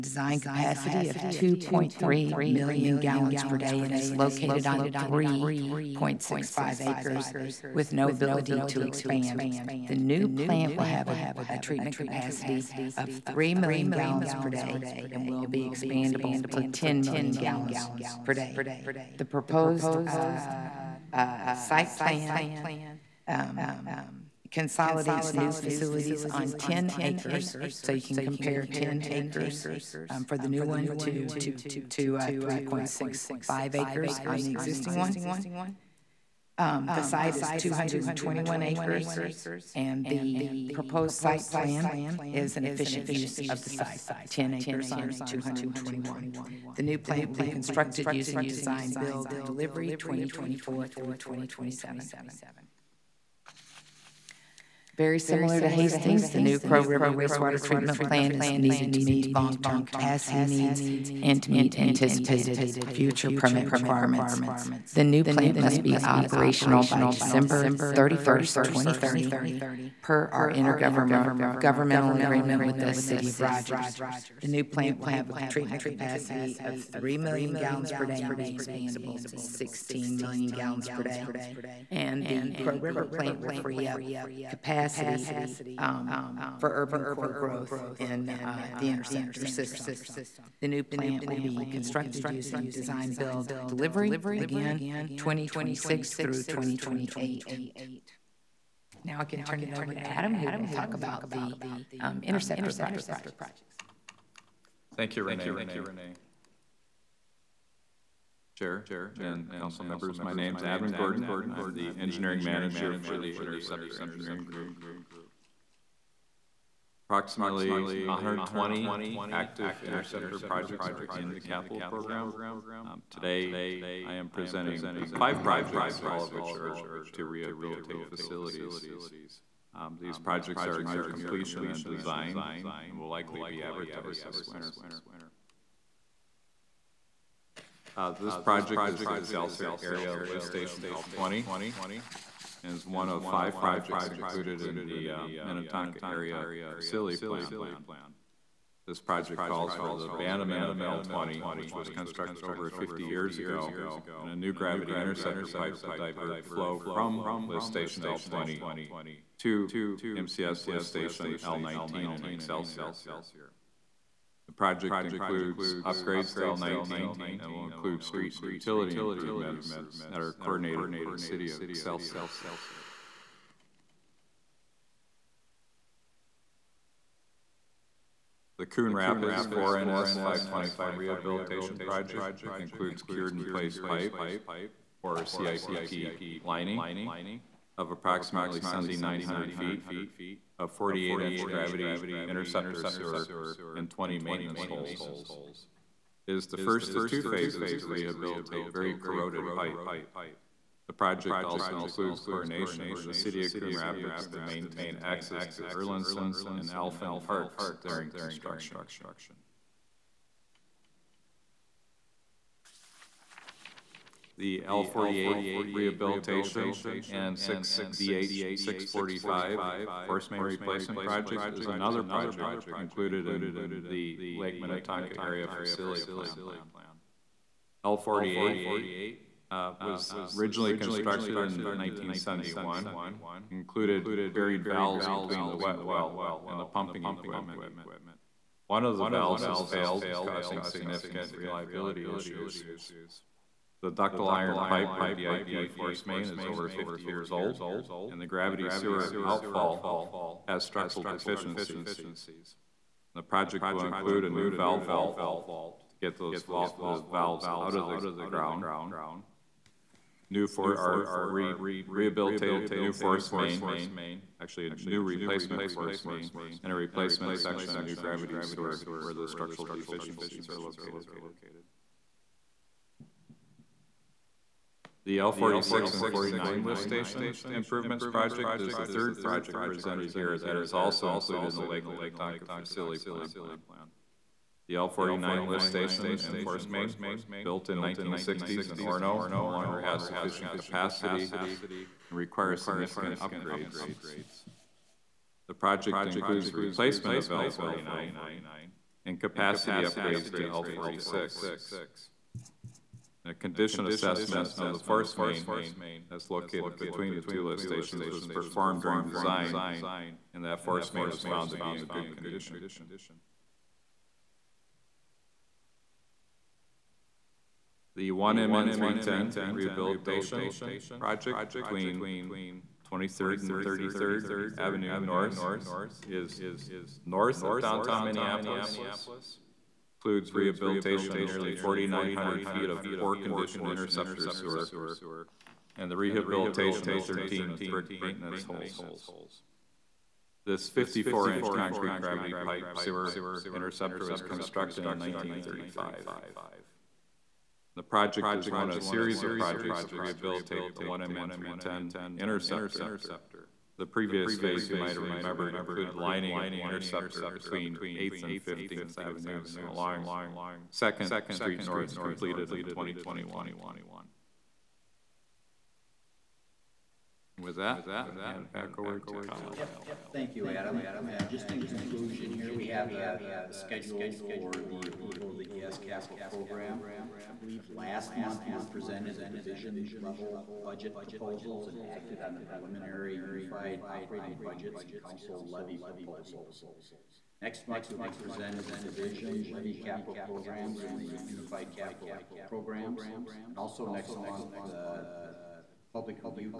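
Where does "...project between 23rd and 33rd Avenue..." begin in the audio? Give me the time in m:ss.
5:20.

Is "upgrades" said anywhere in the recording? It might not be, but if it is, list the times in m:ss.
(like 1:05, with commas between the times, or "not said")
2:45, 4:53, 4:59.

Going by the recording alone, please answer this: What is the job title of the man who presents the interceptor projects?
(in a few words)
Engineering manager.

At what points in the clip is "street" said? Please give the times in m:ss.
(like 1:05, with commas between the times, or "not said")
2:48, 6:01.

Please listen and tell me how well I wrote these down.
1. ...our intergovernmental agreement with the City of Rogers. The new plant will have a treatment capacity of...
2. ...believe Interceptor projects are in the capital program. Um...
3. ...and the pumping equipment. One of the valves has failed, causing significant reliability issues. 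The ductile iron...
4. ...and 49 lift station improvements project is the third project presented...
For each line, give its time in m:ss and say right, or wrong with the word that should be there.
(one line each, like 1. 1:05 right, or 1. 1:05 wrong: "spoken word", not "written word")
1. 1:10 right
2. 1:59 wrong: "active", not "believe"
3. 3:56 right
4. 4:35 right.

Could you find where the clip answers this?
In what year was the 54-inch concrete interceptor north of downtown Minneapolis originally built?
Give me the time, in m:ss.
5:44.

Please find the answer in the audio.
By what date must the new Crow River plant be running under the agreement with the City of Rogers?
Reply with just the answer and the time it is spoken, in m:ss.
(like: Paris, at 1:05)
December 31st, 2030, at 1:07.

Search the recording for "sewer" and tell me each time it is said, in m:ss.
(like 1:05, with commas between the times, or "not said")
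3:12, 4:08, 4:28, 5:34, 5:42.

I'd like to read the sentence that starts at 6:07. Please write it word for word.
With that, I'm going to hand it back over to Kyle.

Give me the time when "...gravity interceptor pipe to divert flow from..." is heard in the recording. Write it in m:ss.
2:34.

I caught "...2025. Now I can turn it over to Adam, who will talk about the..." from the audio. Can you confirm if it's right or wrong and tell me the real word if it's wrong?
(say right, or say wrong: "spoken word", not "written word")
wrong: "2028", not "2025".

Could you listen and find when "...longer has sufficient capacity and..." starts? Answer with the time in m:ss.
4:49.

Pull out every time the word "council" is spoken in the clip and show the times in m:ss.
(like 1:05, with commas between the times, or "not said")
1:49, 6:25.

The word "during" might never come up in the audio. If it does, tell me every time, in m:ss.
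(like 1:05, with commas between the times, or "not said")
3:27, 5:08.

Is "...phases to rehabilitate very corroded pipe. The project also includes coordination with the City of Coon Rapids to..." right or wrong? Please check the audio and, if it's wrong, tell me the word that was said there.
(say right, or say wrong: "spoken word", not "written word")
right.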